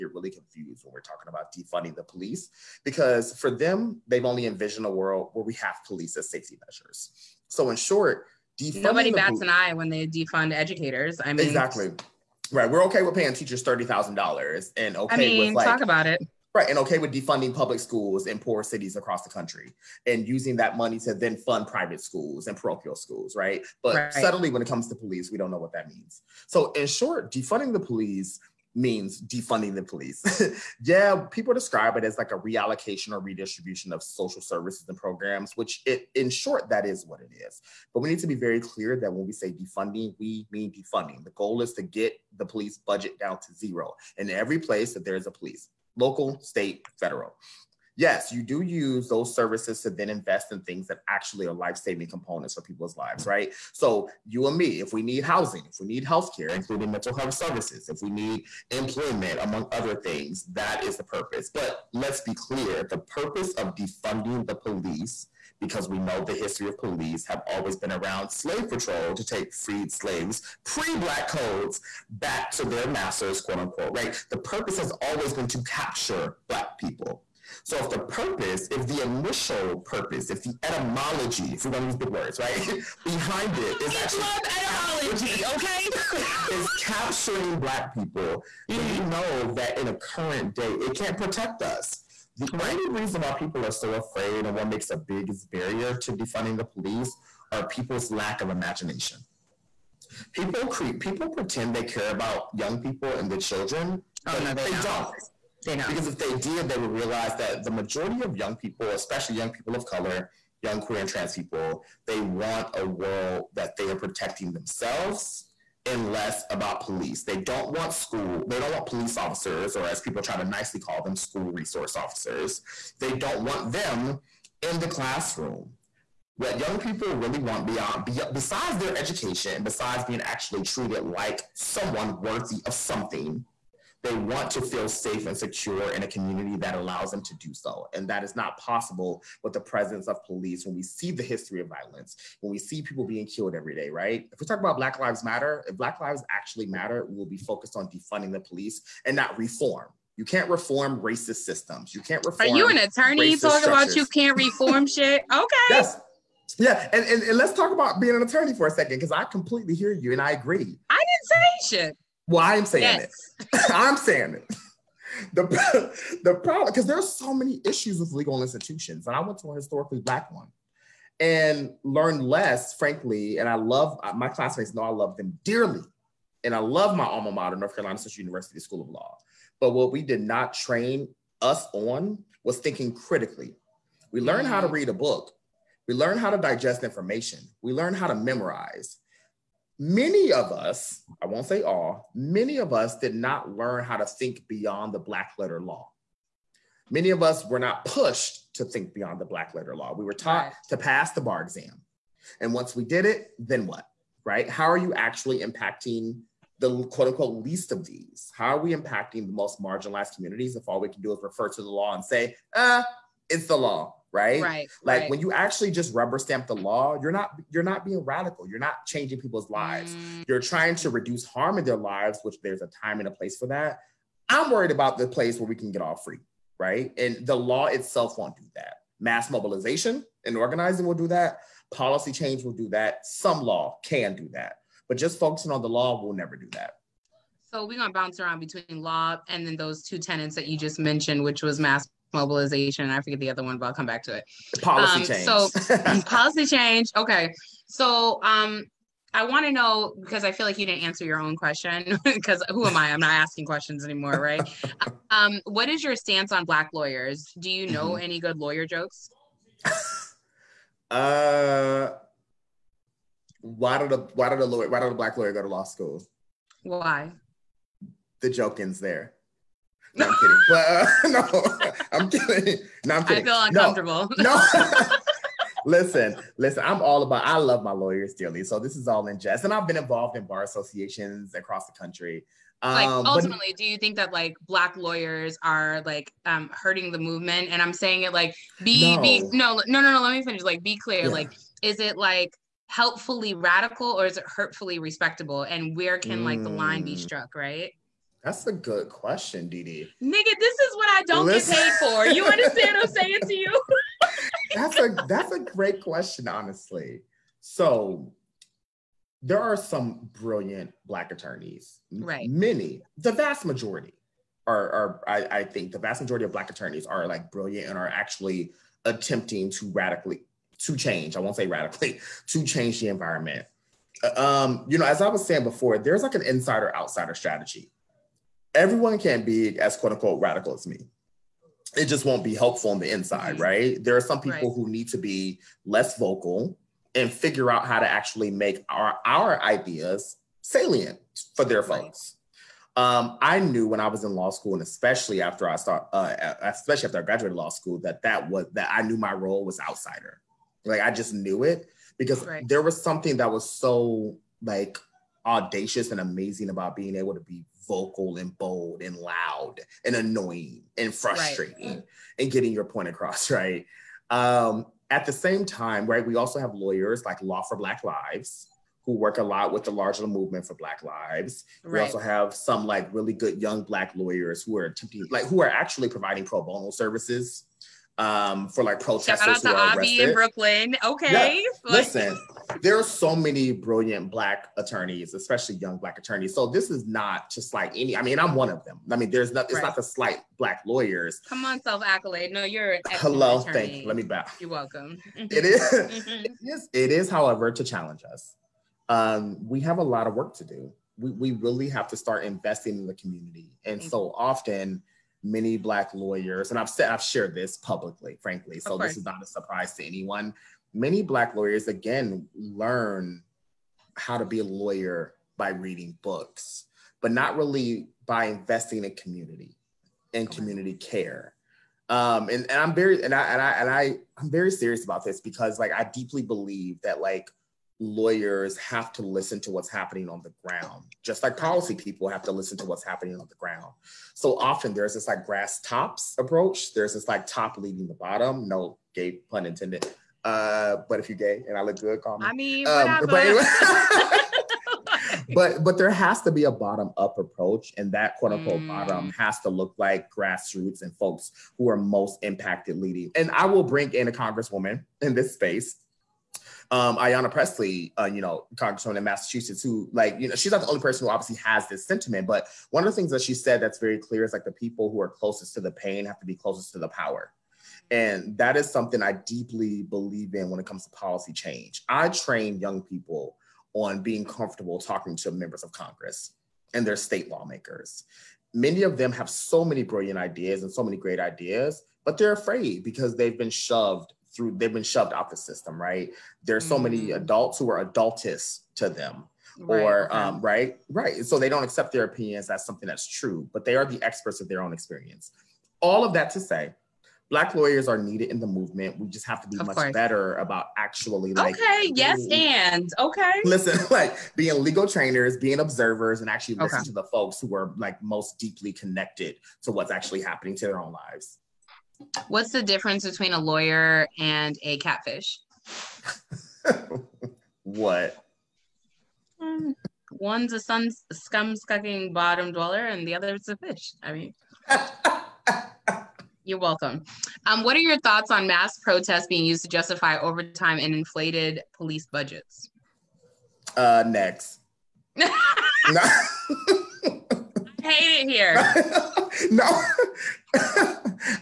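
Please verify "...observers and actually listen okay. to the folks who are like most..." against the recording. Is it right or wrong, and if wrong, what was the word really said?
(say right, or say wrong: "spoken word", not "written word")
right.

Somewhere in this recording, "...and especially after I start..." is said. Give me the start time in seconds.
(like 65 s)
344 s.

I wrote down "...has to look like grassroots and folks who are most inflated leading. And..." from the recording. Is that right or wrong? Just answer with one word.
wrong.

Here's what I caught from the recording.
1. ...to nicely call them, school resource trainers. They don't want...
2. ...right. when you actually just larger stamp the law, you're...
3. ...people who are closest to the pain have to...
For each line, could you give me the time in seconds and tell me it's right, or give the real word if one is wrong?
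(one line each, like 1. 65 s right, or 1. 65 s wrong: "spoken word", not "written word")
1. 120 s wrong: "officers", not "trainers"
2. 215 s wrong: "rubber", not "larger"
3. 464 s right.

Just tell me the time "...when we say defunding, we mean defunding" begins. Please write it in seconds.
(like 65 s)
39 s.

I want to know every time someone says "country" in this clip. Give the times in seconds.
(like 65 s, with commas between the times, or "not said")
19 s, 281 s.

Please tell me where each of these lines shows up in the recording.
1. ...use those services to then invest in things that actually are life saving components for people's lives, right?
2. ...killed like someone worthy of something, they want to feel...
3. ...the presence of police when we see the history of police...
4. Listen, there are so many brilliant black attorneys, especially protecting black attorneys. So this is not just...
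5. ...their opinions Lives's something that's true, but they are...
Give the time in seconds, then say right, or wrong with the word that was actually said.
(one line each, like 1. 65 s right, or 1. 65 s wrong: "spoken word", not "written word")
1. 48 s right
2. 130 s wrong: "treated", not "killed"
3. 139 s wrong: "violence", not "police"
4. 381 s wrong: "young", not "protecting"
5. 491 s wrong: "That", not "Lives".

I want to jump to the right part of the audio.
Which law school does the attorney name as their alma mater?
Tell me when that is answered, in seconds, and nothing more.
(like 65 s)
177 s.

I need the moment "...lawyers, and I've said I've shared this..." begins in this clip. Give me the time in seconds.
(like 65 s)
405 s.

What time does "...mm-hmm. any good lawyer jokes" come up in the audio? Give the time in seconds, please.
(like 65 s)
257 s.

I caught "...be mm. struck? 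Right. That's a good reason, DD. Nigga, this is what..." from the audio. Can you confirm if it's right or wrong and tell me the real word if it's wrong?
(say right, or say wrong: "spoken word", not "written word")
wrong: "question", not "reason".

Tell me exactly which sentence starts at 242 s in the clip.
I forget the other one, but I'll come back to it.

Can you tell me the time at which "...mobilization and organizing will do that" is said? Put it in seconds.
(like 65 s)
229 s.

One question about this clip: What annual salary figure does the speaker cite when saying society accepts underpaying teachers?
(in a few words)
$30,000.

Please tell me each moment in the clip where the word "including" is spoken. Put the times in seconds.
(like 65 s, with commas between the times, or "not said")
56 s.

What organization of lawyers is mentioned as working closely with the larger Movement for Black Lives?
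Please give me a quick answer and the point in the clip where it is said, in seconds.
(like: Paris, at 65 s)
Law for Black Lives, at 367 s.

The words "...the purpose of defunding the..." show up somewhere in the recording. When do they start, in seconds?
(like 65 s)
62 s.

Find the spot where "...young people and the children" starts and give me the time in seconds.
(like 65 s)
102 s.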